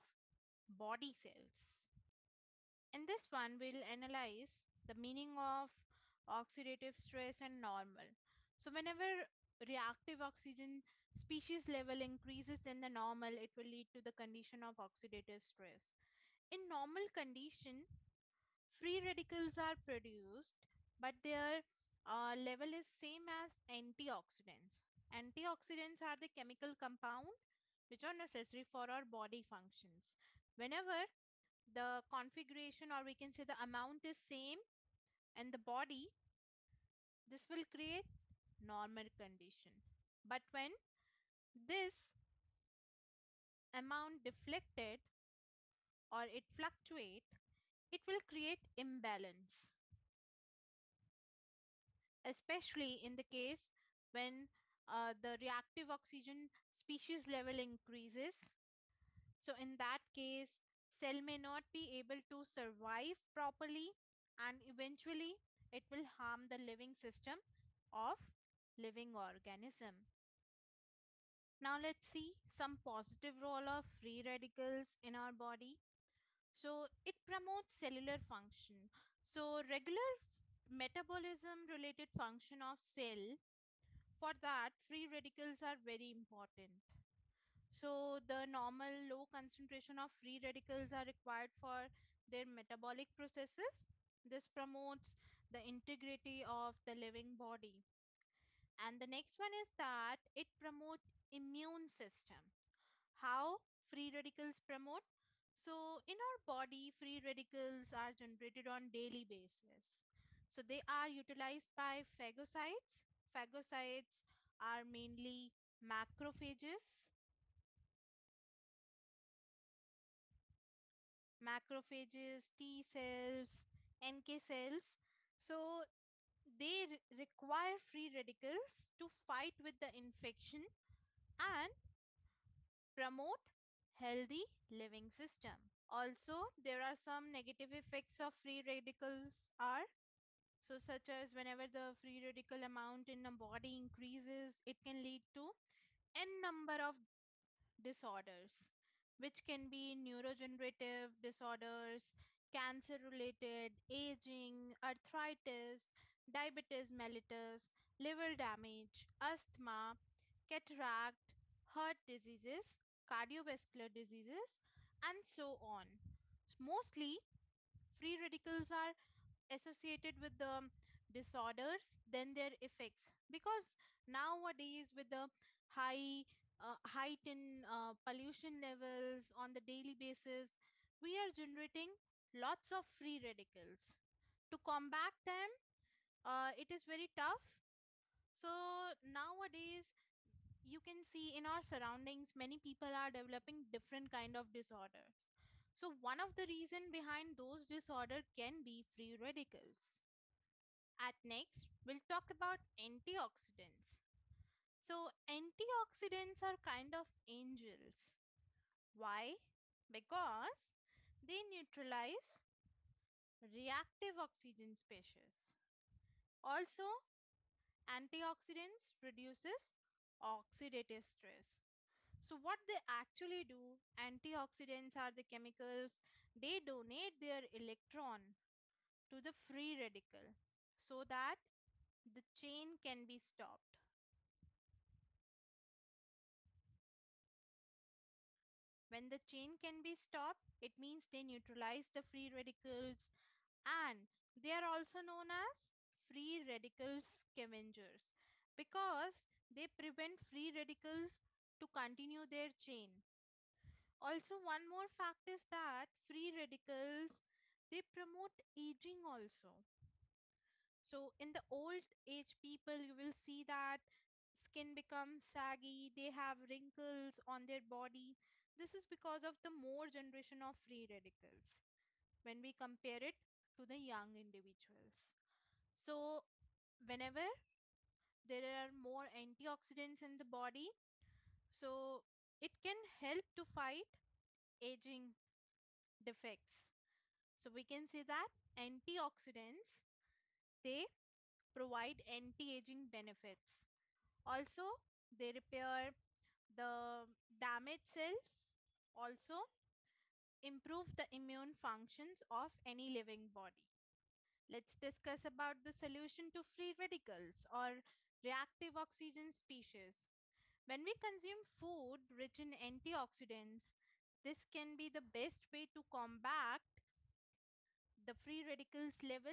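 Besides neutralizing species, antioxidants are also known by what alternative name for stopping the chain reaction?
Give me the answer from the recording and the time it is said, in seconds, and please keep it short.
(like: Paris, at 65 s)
Free radical scavengers, at 245 s.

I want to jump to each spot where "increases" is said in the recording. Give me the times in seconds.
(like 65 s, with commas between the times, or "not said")
12 s, 57 s, 143 s.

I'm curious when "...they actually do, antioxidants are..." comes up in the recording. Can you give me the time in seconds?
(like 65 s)
222 s.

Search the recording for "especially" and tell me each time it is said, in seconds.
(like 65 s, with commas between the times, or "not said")
52 s.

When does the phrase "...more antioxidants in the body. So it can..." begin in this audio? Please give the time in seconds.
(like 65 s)
278 s.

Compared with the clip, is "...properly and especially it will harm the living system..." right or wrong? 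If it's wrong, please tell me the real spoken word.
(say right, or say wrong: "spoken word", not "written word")
wrong: "eventually", not "especially".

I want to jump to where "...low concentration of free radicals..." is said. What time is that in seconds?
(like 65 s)
89 s.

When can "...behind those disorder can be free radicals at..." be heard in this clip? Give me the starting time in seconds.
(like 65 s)
196 s.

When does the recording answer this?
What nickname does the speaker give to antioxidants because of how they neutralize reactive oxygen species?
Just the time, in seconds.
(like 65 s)
207 s.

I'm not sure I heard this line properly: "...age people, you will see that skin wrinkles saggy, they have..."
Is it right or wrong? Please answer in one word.
wrong.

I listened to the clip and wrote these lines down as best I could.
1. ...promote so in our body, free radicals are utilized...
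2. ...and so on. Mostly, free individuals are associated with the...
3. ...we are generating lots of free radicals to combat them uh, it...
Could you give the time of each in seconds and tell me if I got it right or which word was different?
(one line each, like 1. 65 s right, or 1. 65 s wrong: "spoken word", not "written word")
1. 104 s wrong: "generated", not "utilized"
2. 165 s wrong: "radicals", not "individuals"
3. 181 s right.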